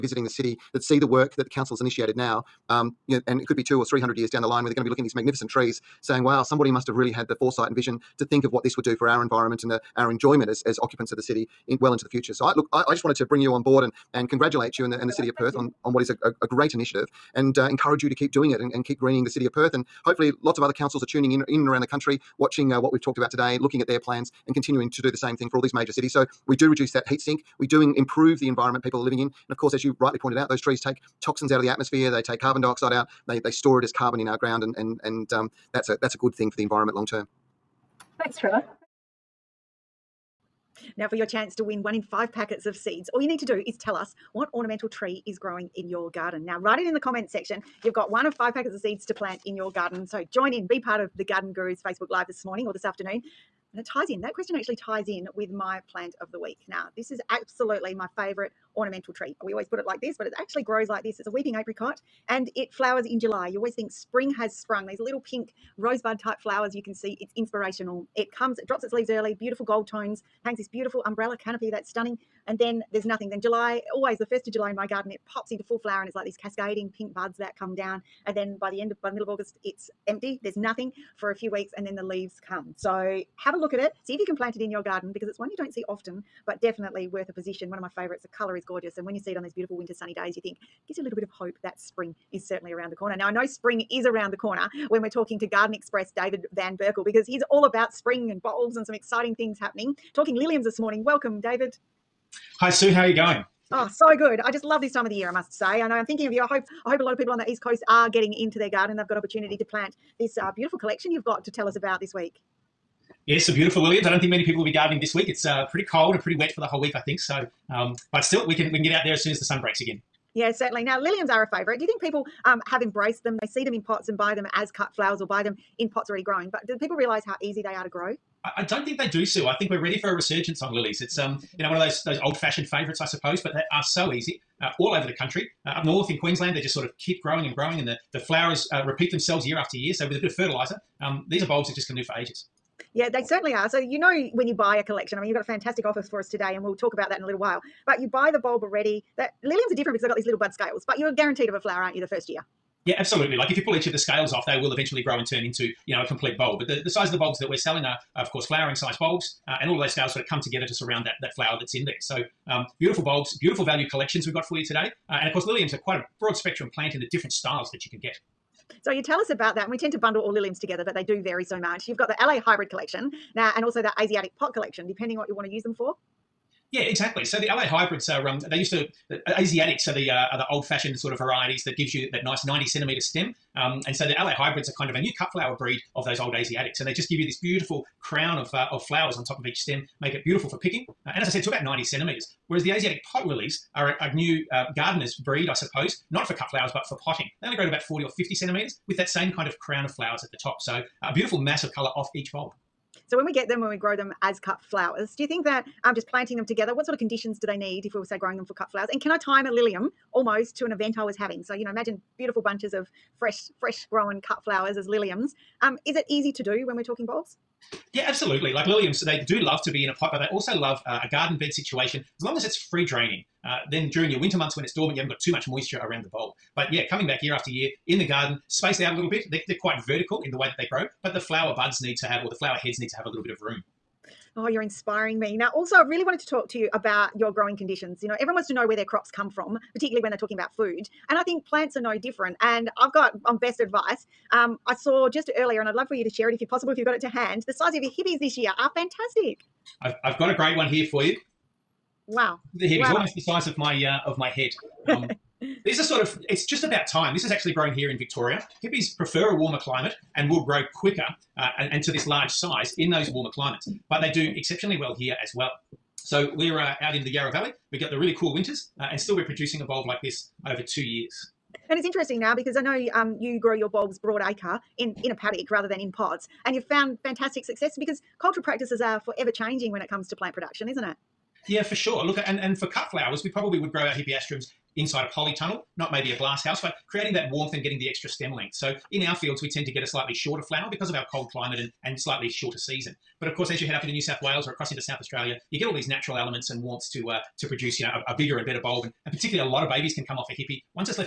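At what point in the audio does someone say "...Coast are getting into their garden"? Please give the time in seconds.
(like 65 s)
107 s.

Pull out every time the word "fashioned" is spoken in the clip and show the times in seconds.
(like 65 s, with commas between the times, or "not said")
132 s, 180 s.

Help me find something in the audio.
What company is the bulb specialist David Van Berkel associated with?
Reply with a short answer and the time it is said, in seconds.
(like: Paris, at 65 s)
Garden Express, at 95 s.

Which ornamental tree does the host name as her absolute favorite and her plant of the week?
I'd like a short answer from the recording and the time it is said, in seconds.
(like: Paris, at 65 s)
Weeping apricot, at 61 s.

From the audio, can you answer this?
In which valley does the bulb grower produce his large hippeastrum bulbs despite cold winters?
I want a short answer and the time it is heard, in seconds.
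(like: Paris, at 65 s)
Yarra Valley, at 267 s.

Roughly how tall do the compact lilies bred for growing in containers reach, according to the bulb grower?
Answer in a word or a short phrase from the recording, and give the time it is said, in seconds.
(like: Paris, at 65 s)
40 or 50 centimeters, at 197 s.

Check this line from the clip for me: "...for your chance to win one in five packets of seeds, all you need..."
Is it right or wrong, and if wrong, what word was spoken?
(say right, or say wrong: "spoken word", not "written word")
right.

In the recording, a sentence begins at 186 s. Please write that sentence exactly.
And they just give you this beautiful crown of, uh, of flowers on top of each stem, make it beautiful for picking.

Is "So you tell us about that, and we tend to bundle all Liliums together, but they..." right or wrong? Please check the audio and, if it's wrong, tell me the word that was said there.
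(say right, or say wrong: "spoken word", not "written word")
right.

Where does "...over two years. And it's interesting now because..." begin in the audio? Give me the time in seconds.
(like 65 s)
270 s.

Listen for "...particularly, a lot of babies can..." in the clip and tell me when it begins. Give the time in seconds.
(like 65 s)
299 s.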